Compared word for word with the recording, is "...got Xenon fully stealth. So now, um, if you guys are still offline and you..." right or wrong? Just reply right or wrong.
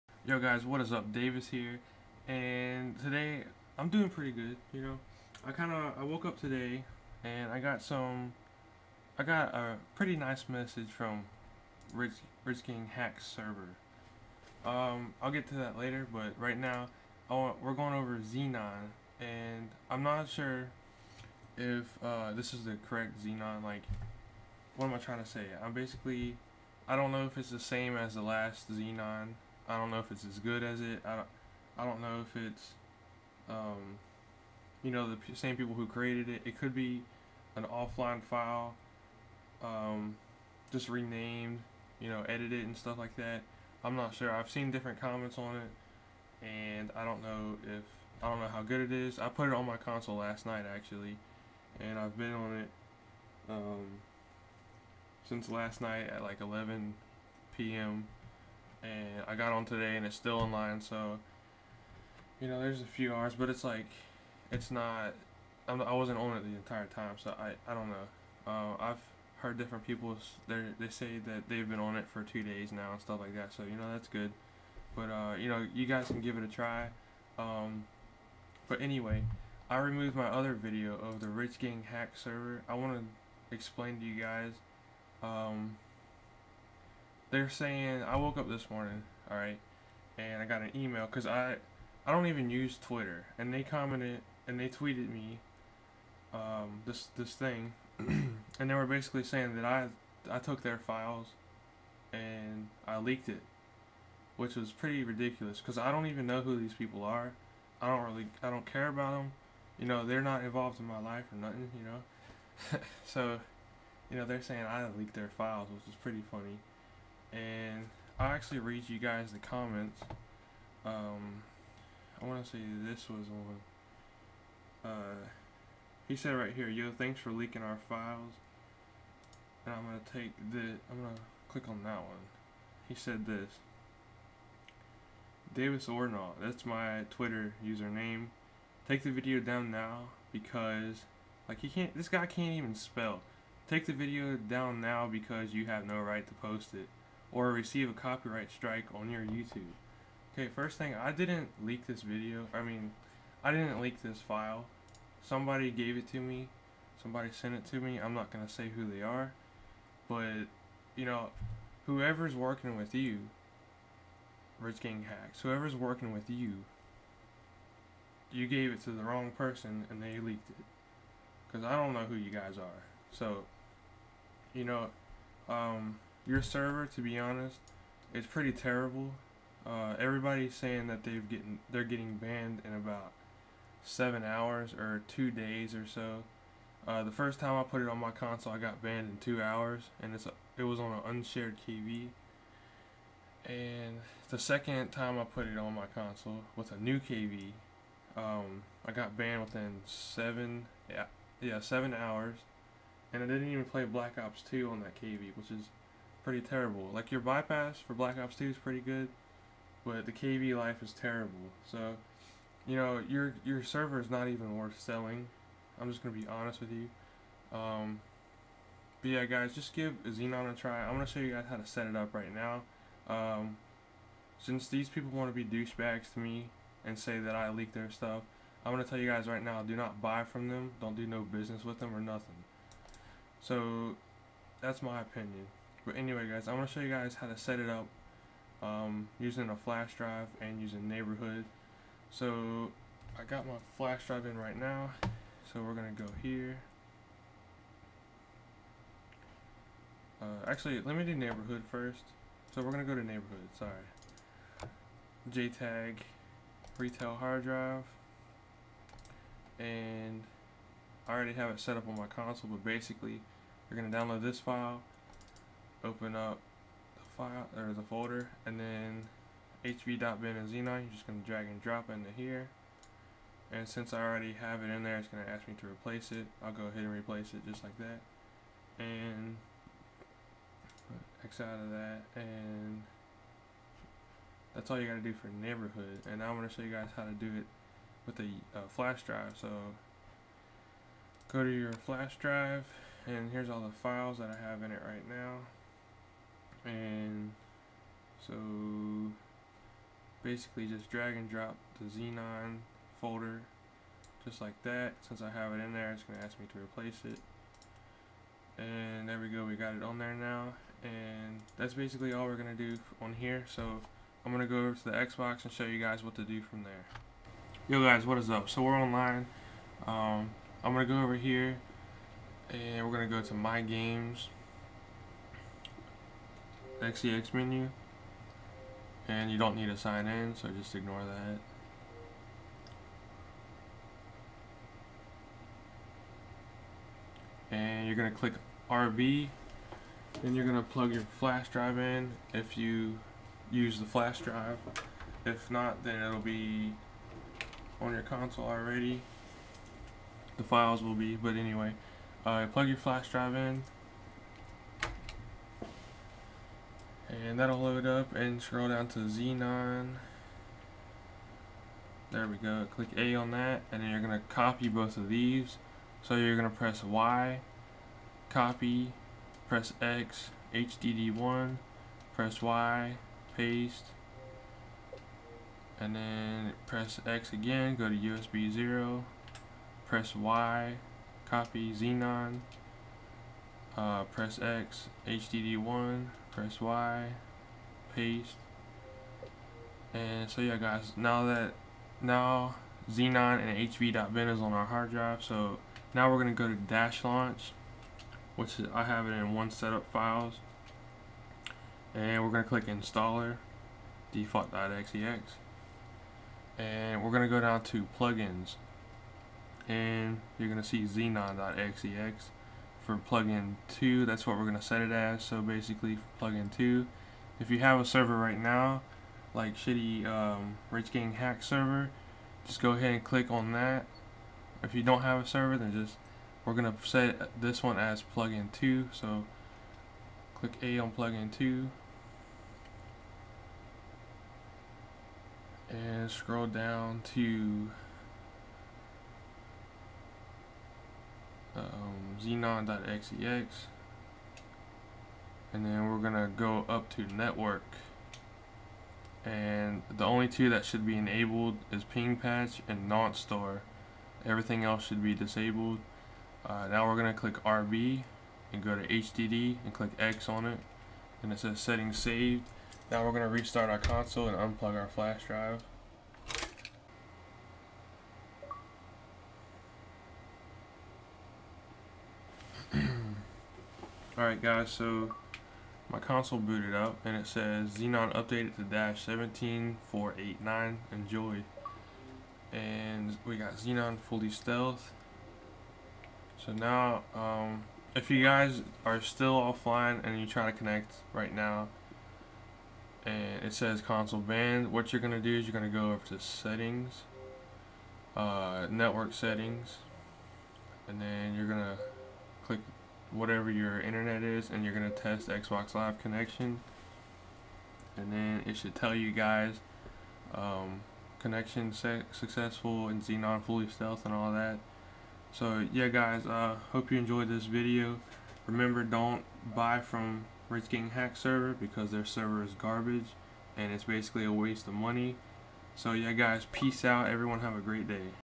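right.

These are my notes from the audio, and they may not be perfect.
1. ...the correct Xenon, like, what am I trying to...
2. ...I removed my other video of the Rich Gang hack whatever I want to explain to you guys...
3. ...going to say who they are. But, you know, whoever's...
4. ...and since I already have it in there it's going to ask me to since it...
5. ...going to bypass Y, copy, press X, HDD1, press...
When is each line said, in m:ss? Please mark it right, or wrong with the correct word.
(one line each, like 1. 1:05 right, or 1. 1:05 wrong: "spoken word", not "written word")
1. 0:22 right
2. 1:19 wrong: "server", not "whatever"
3. 2:38 right
4. 4:33 wrong: "replace", not "since"
5. 6:06 wrong: "press", not "bypass".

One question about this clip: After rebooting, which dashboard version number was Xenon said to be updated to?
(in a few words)
17489.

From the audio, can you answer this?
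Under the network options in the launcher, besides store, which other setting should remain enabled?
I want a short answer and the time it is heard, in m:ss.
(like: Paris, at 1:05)
Ping patch, at 7:31.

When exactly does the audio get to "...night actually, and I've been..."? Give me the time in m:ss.
0:50.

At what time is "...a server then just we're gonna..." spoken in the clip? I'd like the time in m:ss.
7:05.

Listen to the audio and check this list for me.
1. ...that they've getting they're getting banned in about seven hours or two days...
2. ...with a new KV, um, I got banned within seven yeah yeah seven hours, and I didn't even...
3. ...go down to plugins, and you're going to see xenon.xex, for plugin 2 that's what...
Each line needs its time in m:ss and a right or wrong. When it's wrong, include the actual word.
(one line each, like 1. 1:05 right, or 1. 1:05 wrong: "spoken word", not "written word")
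1. 3:00 right
2. 3:16 right
3. 6:47 right.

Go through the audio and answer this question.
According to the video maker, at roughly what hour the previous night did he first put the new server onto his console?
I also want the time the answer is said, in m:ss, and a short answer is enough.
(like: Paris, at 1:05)
11 p.m., at 0:56.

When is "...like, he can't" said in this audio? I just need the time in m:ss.
2:21.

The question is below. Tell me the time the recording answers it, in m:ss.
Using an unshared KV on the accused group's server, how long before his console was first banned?
3:09.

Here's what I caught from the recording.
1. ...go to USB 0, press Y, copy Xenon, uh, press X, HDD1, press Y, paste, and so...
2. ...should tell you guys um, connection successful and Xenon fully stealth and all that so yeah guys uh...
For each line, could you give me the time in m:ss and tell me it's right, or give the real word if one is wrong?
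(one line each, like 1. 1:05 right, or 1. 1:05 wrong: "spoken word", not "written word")
1. 6:17 right
2. 8:28 right.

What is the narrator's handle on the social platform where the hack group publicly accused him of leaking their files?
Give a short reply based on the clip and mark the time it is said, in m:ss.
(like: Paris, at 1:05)
Davis Ornaw, at 2:15.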